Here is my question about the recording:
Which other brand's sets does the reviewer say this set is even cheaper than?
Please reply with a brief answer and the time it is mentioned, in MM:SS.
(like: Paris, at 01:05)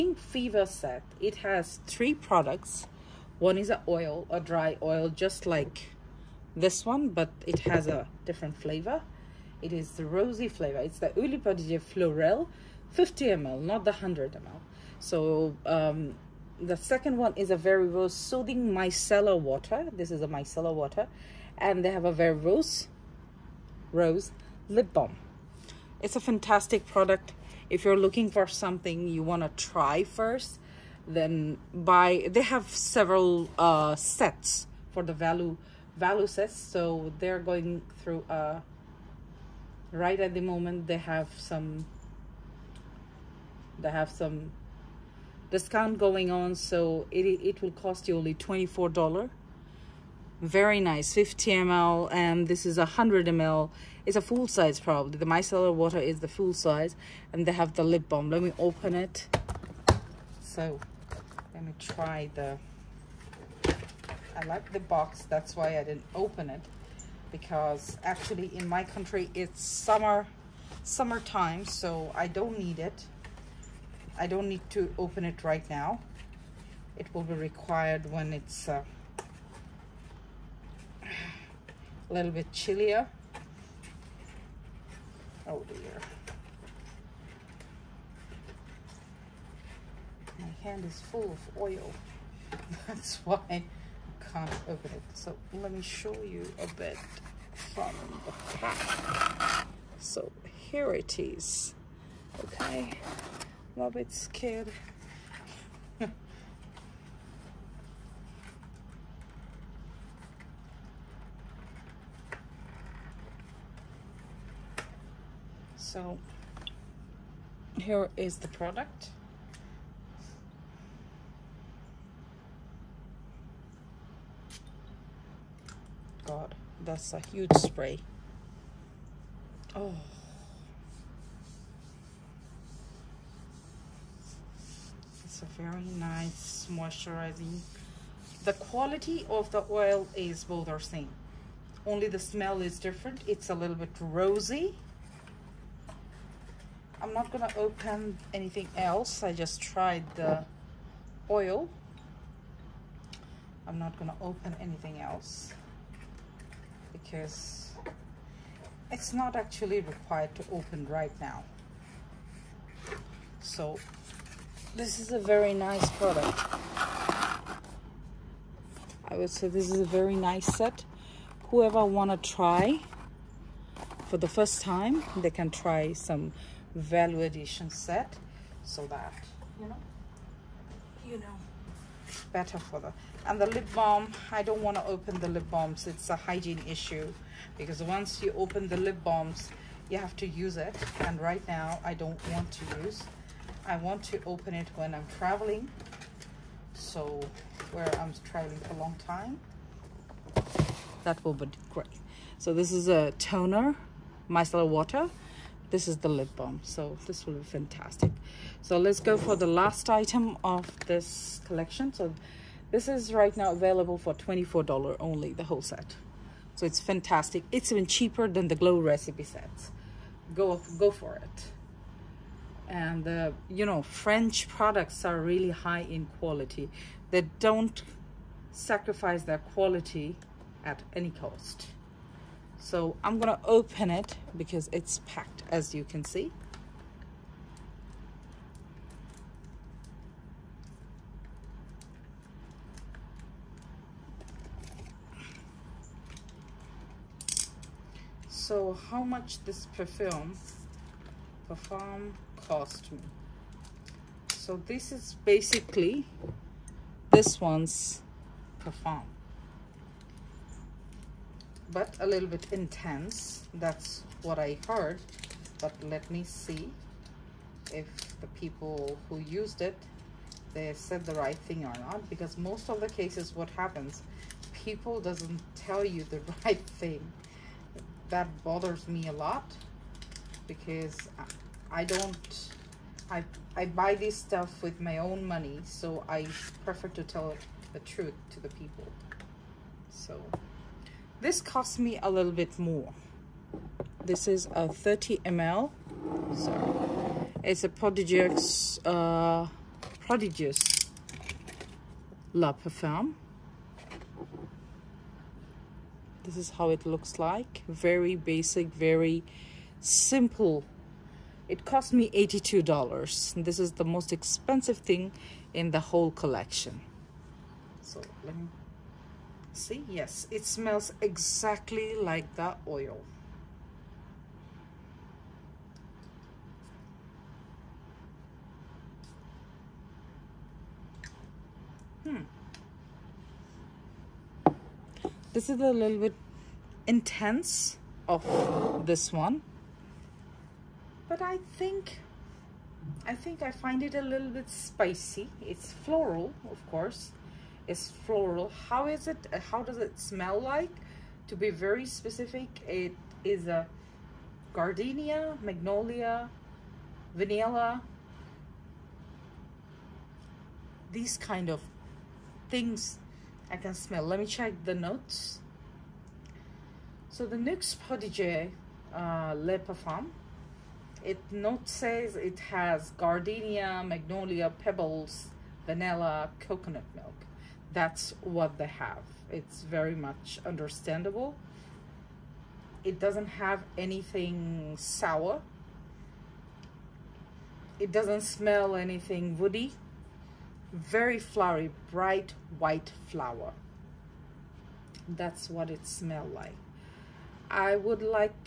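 Glow Recipe, at 03:38.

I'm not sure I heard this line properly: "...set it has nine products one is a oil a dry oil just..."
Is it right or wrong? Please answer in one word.
wrong.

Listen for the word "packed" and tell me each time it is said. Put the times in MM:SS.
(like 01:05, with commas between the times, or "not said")
03:55.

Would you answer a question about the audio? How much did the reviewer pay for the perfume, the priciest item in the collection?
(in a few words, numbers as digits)
$82.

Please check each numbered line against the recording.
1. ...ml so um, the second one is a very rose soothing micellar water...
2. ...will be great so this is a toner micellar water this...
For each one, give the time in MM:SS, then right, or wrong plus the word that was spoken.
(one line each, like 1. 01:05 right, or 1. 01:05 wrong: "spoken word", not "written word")
1. 00:14 right
2. 03:21 right.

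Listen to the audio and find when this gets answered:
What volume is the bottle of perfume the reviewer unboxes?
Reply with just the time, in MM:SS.
04:54.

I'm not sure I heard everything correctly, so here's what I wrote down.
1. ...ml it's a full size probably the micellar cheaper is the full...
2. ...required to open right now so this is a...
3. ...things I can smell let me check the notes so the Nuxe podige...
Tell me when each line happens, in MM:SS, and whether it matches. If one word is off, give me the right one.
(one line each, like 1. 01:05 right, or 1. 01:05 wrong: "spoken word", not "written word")
1. 00:53 wrong: "water", not "cheaper"
2. 02:39 right
3. 06:02 right.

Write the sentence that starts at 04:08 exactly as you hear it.
So how much this perfume perfume cost me?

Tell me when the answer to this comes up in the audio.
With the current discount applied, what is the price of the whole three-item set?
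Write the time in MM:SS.
00:48.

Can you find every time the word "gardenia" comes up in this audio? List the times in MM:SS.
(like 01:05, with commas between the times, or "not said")
05:54, 06:12.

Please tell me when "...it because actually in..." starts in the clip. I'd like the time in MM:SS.
01:06.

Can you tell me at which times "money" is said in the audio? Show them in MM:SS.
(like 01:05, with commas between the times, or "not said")
04:45.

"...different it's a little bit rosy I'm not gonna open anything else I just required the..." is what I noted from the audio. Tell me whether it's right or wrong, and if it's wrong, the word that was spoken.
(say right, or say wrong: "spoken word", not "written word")
wrong: "tried", not "required".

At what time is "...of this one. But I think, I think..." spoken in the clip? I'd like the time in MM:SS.
05:38.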